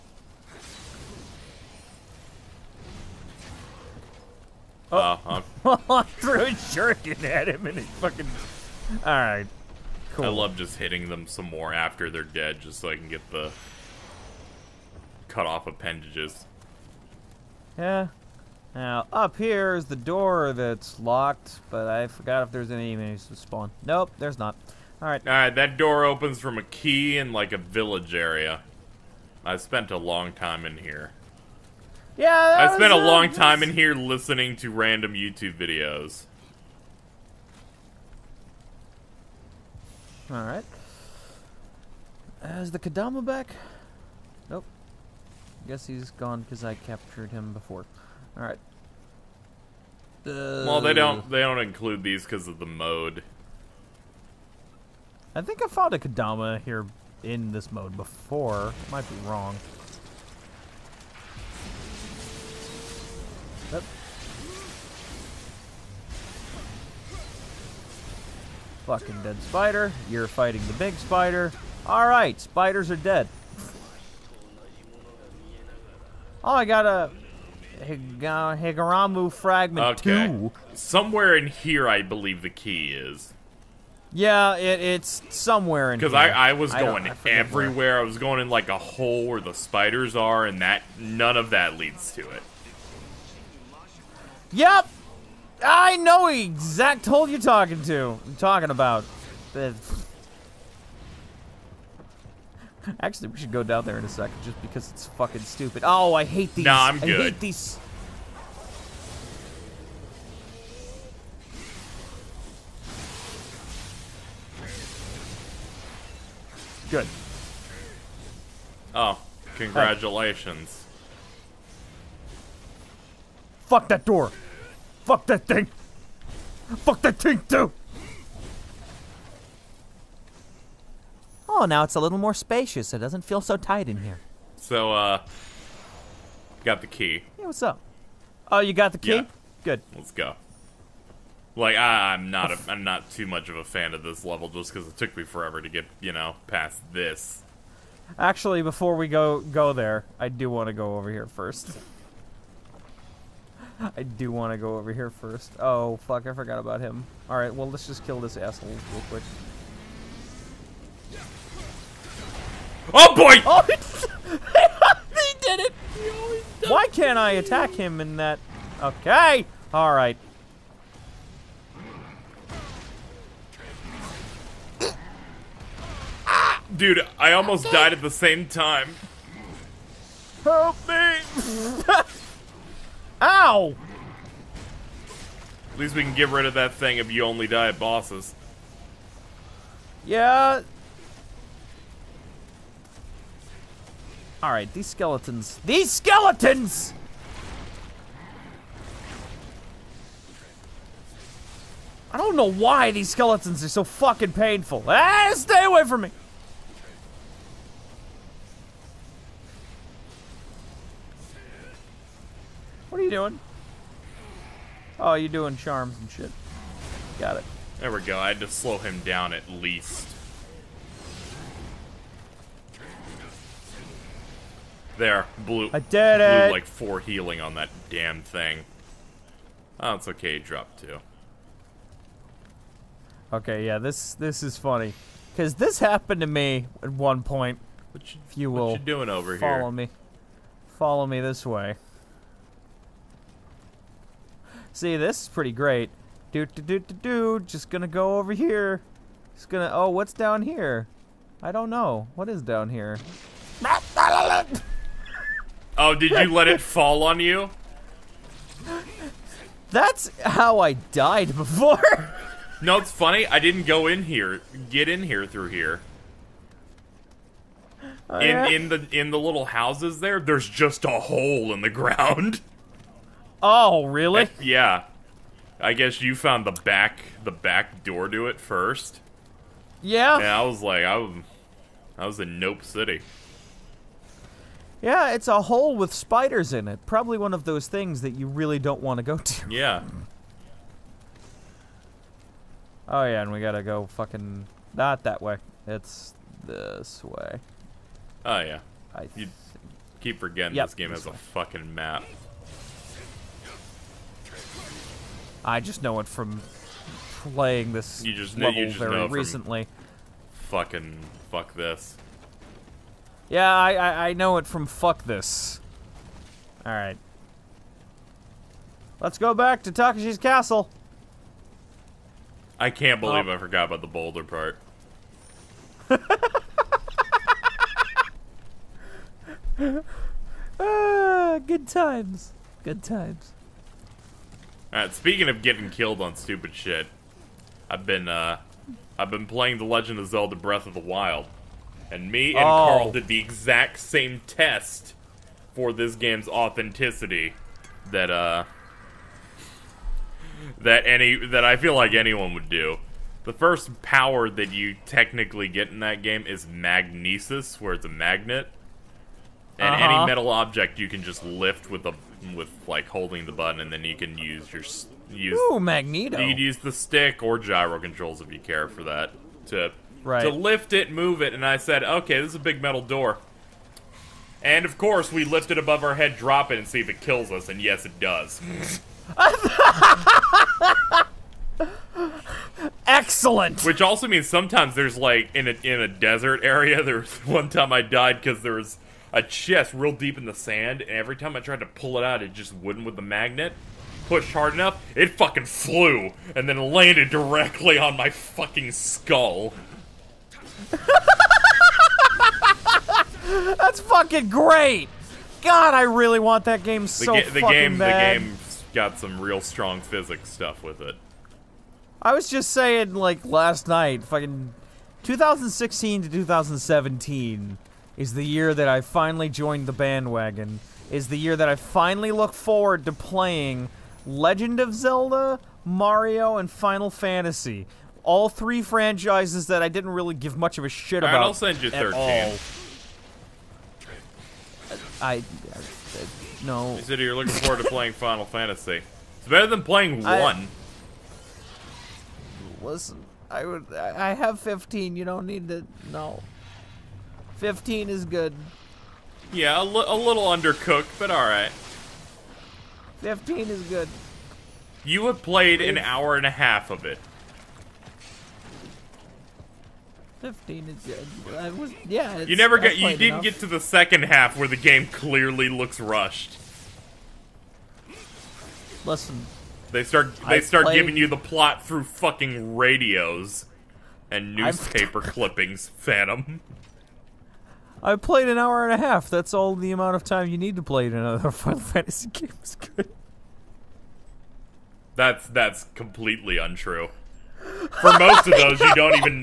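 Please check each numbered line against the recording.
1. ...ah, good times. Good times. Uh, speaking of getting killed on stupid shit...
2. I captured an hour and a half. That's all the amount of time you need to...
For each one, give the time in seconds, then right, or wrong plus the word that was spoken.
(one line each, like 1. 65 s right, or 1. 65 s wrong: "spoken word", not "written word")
1. 330 s right
2. 477 s wrong: "played", not "captured".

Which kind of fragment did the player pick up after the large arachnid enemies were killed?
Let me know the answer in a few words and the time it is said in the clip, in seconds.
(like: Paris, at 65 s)
Higuramu Fragment, at 78 s.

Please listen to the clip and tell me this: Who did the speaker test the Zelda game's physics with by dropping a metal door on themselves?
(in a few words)
Carl.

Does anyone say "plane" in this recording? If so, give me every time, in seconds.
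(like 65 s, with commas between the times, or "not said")
not said.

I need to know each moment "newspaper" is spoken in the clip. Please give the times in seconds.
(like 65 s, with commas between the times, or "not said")
474 s.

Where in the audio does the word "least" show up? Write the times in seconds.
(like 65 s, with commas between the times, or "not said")
185 s, 219 s.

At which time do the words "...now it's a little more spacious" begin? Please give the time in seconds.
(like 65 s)
131 s.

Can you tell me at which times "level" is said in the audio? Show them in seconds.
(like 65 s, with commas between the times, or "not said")
144 s, 308 s.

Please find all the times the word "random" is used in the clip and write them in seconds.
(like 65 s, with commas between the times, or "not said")
34 s.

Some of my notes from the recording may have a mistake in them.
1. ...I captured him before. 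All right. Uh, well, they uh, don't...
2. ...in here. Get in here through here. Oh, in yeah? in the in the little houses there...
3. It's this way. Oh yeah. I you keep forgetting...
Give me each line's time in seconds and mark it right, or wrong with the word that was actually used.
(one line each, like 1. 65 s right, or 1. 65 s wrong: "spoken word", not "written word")
1. 46 s right
2. 263 s right
3. 295 s right.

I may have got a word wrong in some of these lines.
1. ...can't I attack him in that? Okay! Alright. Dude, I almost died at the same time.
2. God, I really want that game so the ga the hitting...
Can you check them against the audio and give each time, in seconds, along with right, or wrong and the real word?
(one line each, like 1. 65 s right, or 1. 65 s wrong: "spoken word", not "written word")
1. 166 s right
2. 405 s wrong: "fucking", not "hitting".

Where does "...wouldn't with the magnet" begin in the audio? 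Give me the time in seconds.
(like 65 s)
392 s.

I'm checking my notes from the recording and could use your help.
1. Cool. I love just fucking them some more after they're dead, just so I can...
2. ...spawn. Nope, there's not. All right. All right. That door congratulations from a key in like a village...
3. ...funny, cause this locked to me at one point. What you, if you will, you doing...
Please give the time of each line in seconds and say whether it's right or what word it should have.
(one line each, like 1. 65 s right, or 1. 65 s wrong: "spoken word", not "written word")
1. 10 s wrong: "hitting", not "fucking"
2. 23 s wrong: "opens", not "congratulations"
3. 234 s wrong: "happened", not "locked".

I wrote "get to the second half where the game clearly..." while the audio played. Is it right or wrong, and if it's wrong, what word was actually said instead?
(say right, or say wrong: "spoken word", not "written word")
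right.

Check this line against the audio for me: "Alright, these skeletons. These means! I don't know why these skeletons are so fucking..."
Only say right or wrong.
wrong.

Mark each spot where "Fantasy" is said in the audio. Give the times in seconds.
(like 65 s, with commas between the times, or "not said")
426 s, 438 s, 481 s.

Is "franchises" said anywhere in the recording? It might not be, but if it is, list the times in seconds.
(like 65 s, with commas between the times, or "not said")
428 s.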